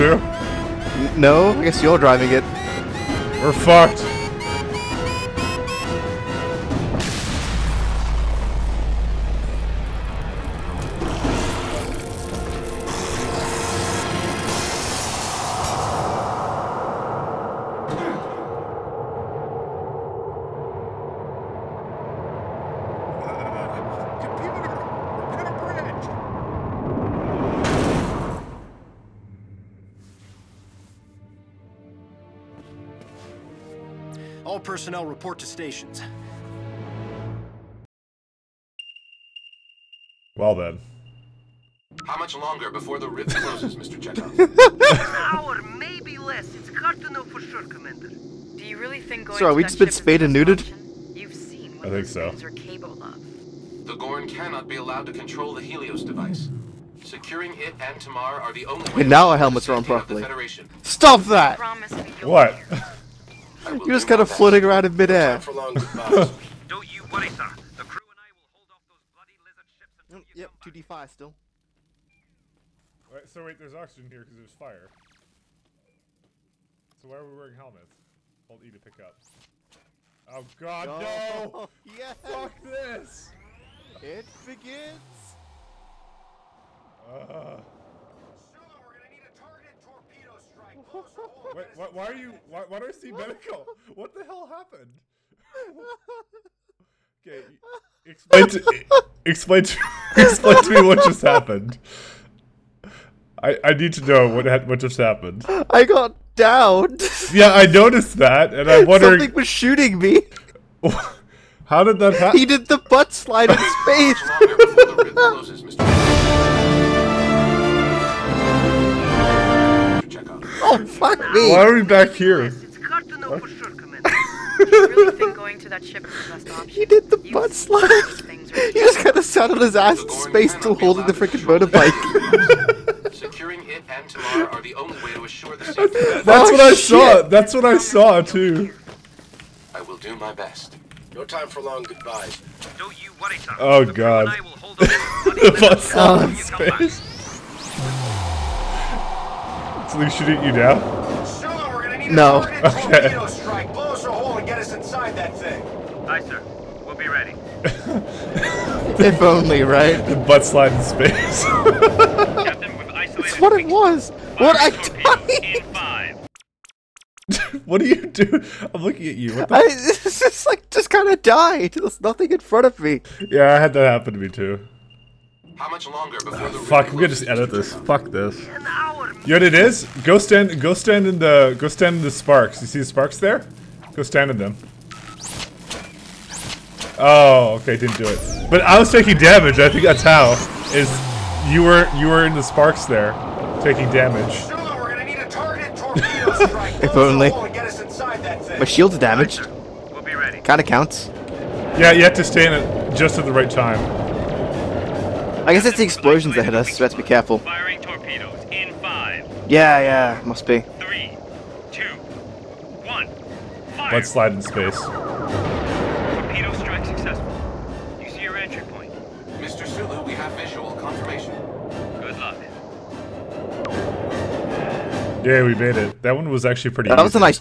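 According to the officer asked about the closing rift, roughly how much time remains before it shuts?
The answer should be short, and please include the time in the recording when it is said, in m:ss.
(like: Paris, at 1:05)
An hour, at 0:44.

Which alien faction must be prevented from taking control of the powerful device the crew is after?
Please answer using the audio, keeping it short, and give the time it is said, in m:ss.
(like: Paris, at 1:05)
The Gorn, at 0:53.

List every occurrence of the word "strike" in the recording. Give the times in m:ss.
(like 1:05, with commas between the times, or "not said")
1:30, 2:33, 3:36.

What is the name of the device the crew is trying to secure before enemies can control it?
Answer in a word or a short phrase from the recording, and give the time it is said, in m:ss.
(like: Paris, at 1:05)
Helios device, at 0:55.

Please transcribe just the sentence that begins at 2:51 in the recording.
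There's nothing in front of me.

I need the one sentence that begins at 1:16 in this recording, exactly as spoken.
So why are we wearing helmets?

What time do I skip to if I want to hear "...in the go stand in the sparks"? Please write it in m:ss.
3:01.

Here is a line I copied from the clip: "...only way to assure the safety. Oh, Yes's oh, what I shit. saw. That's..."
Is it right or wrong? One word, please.
wrong.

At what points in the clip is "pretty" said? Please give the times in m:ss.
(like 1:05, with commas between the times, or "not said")
3:46.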